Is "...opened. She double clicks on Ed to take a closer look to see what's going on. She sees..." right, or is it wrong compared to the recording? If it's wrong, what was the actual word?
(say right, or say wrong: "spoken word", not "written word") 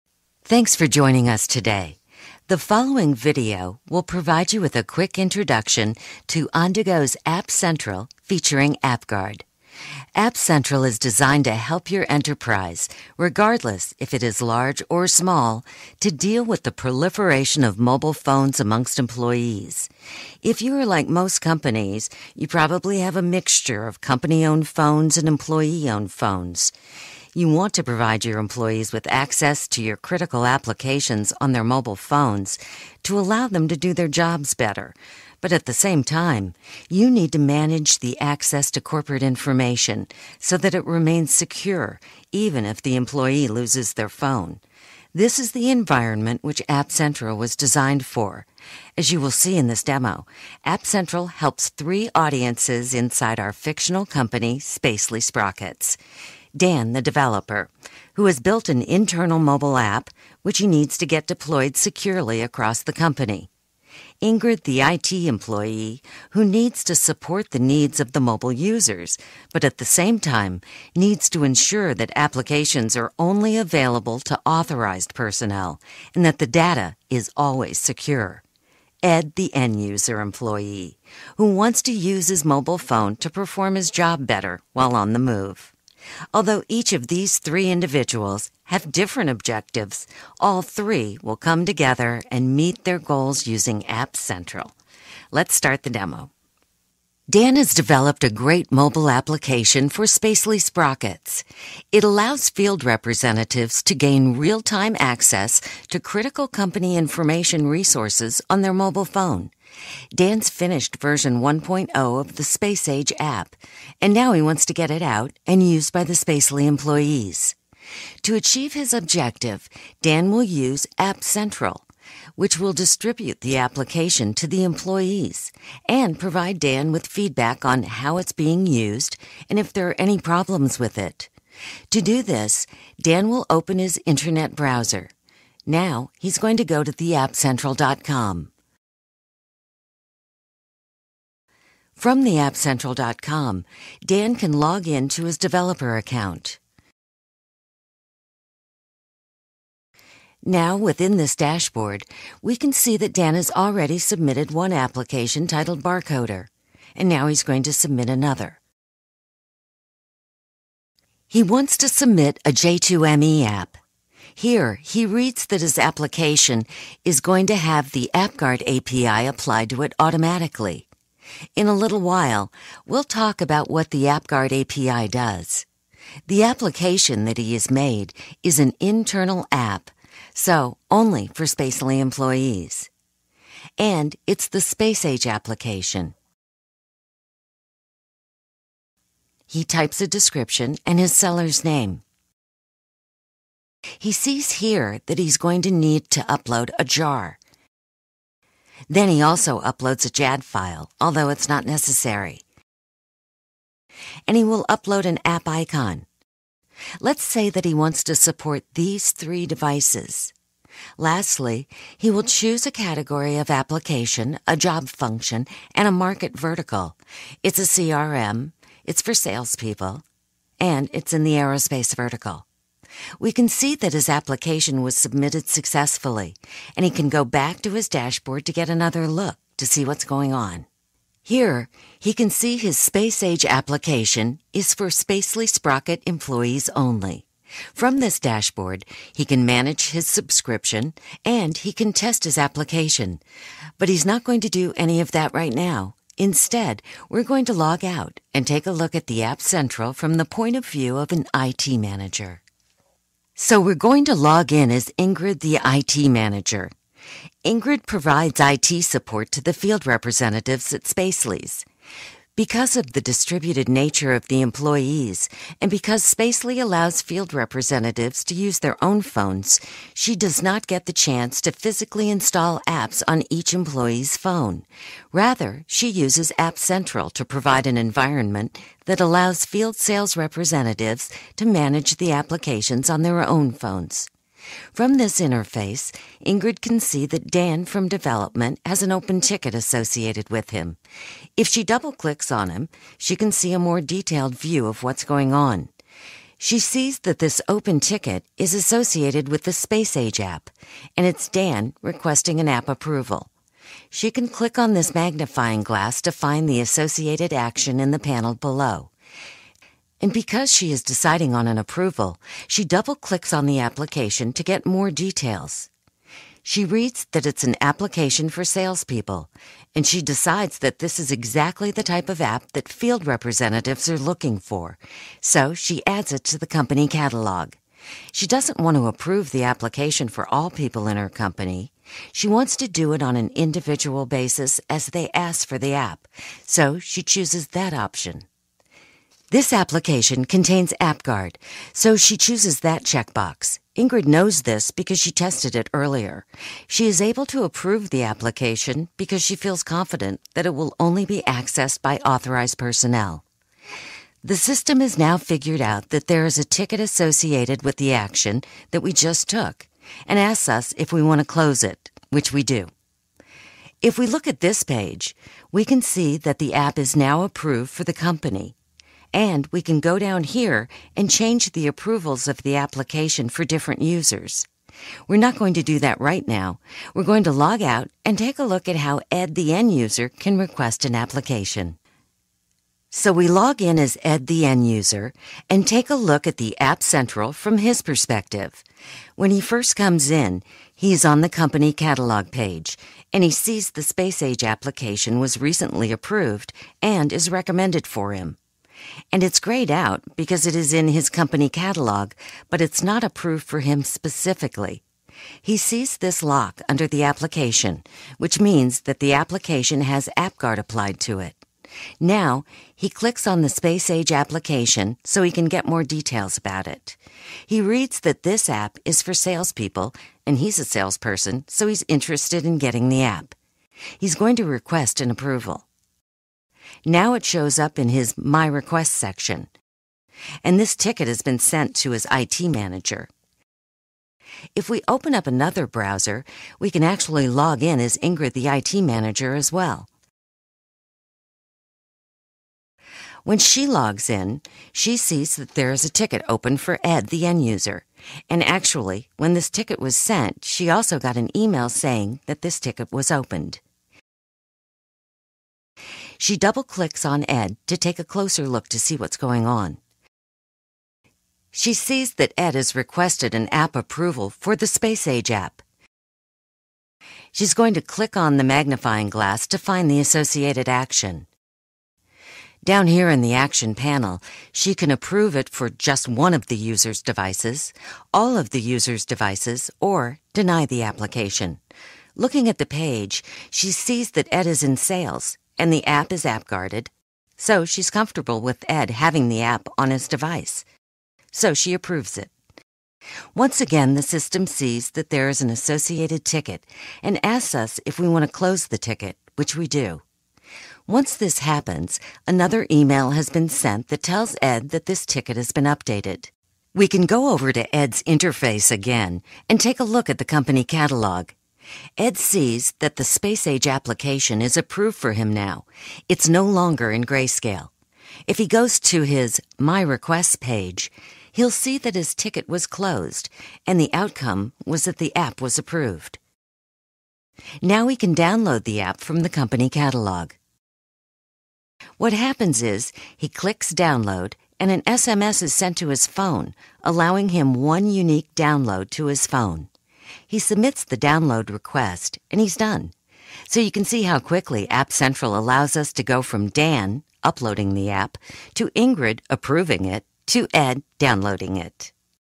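right.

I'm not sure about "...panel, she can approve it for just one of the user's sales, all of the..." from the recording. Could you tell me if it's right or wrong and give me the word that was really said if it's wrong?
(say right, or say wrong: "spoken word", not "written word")
wrong: "devices", not "sales".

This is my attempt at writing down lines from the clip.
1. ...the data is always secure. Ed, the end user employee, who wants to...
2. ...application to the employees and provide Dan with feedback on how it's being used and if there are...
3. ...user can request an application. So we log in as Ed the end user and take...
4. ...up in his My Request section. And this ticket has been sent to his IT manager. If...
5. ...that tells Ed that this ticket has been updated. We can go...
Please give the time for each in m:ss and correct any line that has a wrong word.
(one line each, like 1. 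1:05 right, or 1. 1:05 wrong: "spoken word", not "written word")
1. 1:16 right
2. 2:03 right
3. 6:19 right
4. 7:07 right
5. 8:23 right.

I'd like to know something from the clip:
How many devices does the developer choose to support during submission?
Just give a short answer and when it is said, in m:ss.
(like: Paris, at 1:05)
3, at 3:29.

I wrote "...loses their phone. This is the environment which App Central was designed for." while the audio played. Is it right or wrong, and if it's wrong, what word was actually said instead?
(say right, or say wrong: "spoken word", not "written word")
right.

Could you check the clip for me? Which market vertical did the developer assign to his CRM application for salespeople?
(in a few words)
aerospace.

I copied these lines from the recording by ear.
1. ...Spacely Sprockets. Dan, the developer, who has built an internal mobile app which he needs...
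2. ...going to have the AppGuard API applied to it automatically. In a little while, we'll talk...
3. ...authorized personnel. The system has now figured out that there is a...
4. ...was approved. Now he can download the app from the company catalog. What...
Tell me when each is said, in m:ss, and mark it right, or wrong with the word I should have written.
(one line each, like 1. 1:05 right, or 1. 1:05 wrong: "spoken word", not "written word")
1. 0:54 right
2. 2:47 right
3. 5:51 right
4. 8:45 right.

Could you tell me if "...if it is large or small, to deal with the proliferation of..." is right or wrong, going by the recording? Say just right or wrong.
right.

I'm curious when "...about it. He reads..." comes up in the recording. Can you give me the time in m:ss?
6:56.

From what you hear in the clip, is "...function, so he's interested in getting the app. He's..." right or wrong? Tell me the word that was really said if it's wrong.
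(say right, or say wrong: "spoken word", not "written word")
wrong: "salesperson", not "function".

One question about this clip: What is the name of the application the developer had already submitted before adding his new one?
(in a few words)
Barcoder.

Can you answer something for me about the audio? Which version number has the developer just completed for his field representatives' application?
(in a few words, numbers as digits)
1.0.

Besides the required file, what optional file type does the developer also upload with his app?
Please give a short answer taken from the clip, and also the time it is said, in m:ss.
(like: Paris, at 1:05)
JAD, at 3:20.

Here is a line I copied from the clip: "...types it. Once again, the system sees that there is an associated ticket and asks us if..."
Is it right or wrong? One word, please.
wrong.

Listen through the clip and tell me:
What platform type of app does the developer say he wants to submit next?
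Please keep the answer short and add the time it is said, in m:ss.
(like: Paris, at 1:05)
J2ME, at 2:42.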